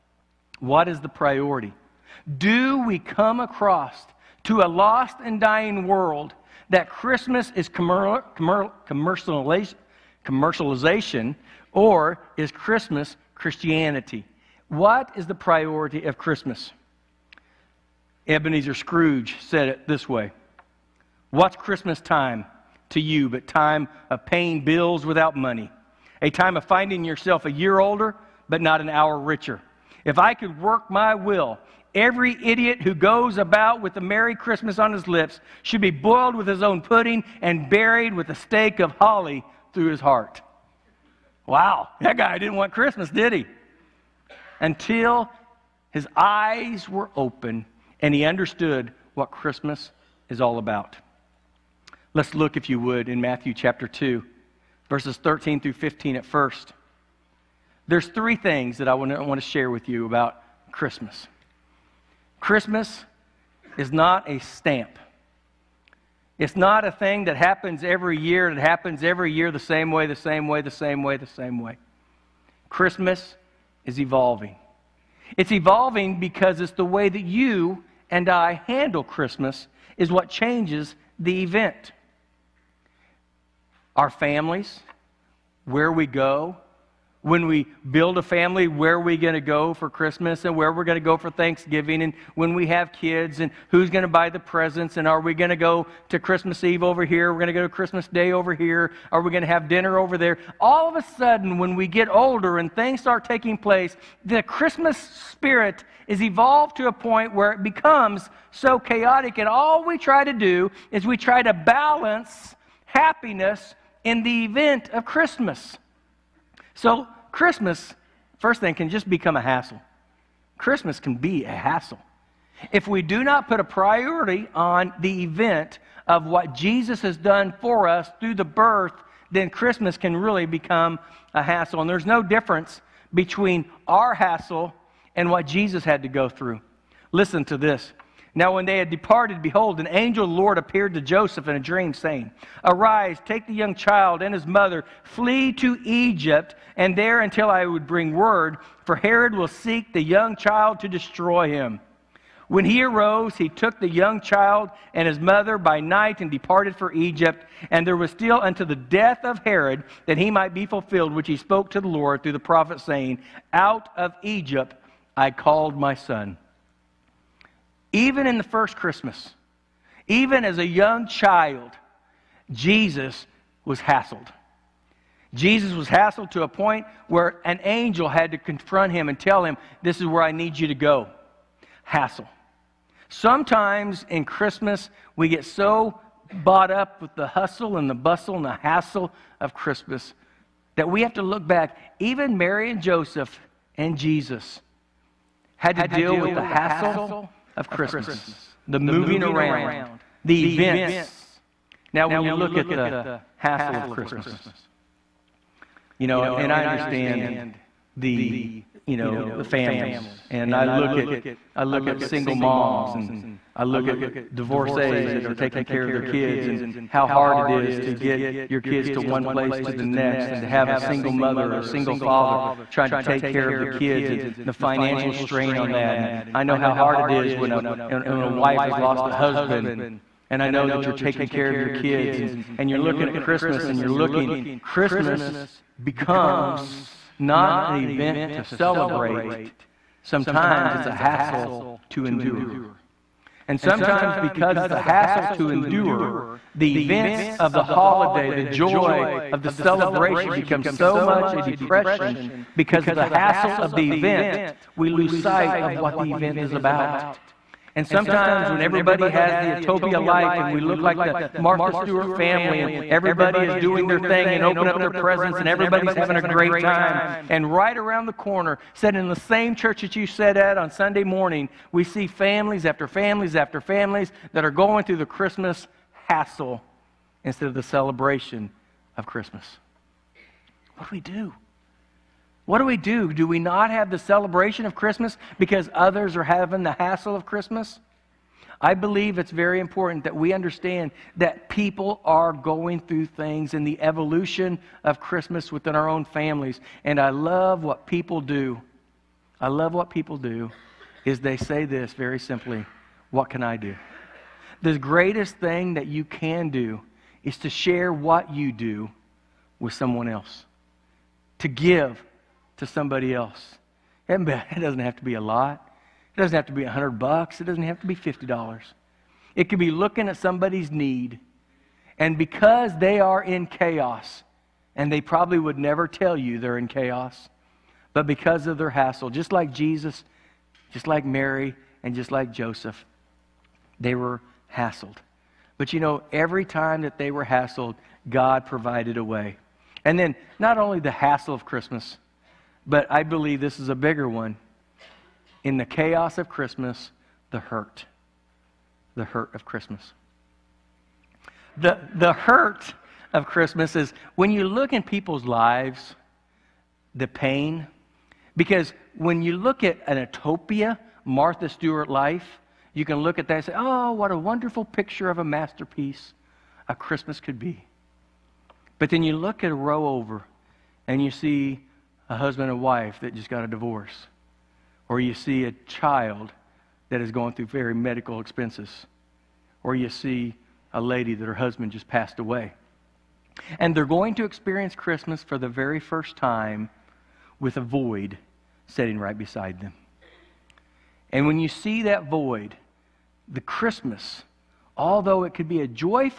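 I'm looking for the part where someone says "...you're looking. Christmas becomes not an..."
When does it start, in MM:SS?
03:53.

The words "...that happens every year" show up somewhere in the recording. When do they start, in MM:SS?
01:07.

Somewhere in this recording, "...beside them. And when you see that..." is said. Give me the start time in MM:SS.
06:29.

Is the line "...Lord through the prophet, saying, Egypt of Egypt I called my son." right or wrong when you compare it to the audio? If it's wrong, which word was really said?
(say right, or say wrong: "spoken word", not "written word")
wrong: "Out", not "Egypt".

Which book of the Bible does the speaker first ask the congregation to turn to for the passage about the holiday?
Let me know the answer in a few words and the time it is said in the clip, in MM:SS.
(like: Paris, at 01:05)
Matthew, at 00:53.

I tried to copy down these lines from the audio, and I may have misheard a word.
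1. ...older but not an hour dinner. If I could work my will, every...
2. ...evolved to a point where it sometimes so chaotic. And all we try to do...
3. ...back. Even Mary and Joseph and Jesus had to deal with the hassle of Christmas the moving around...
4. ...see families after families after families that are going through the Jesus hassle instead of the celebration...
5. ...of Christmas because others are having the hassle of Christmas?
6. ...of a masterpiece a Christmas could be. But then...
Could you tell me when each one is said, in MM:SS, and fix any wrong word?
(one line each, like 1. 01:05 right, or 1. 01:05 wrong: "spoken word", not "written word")
1. 00:27 wrong: "richer", not "dinner"
2. 01:46 wrong: "becomes", not "sometimes"
3. 03:11 right
4. 04:31 wrong: "Christmas", not "Jesus"
5. 04:44 right
6. 06:05 right.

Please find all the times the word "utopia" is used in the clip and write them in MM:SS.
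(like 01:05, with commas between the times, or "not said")
04:19, 05:59.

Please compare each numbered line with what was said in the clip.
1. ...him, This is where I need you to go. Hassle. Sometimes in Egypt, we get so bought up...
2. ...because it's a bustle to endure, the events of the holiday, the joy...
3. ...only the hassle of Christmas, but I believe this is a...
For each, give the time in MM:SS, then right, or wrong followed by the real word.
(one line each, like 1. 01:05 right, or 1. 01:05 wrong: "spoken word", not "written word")
1. 02:59 wrong: "Christmas", not "Egypt"
2. 04:04 wrong: "hassle", not "bustle"
3. 05:40 right.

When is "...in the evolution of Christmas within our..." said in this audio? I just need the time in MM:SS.
04:53.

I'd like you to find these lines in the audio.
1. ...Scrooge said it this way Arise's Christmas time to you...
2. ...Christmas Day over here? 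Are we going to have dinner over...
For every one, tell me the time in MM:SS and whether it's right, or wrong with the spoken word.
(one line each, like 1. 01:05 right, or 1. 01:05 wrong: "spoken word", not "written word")
1. 00:18 wrong: "What", not "Arise"
2. 01:37 right.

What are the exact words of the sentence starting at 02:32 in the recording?
When he arose, he took the young child and his mother by night and departed for Egypt.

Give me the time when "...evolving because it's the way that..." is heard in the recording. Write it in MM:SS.
01:15.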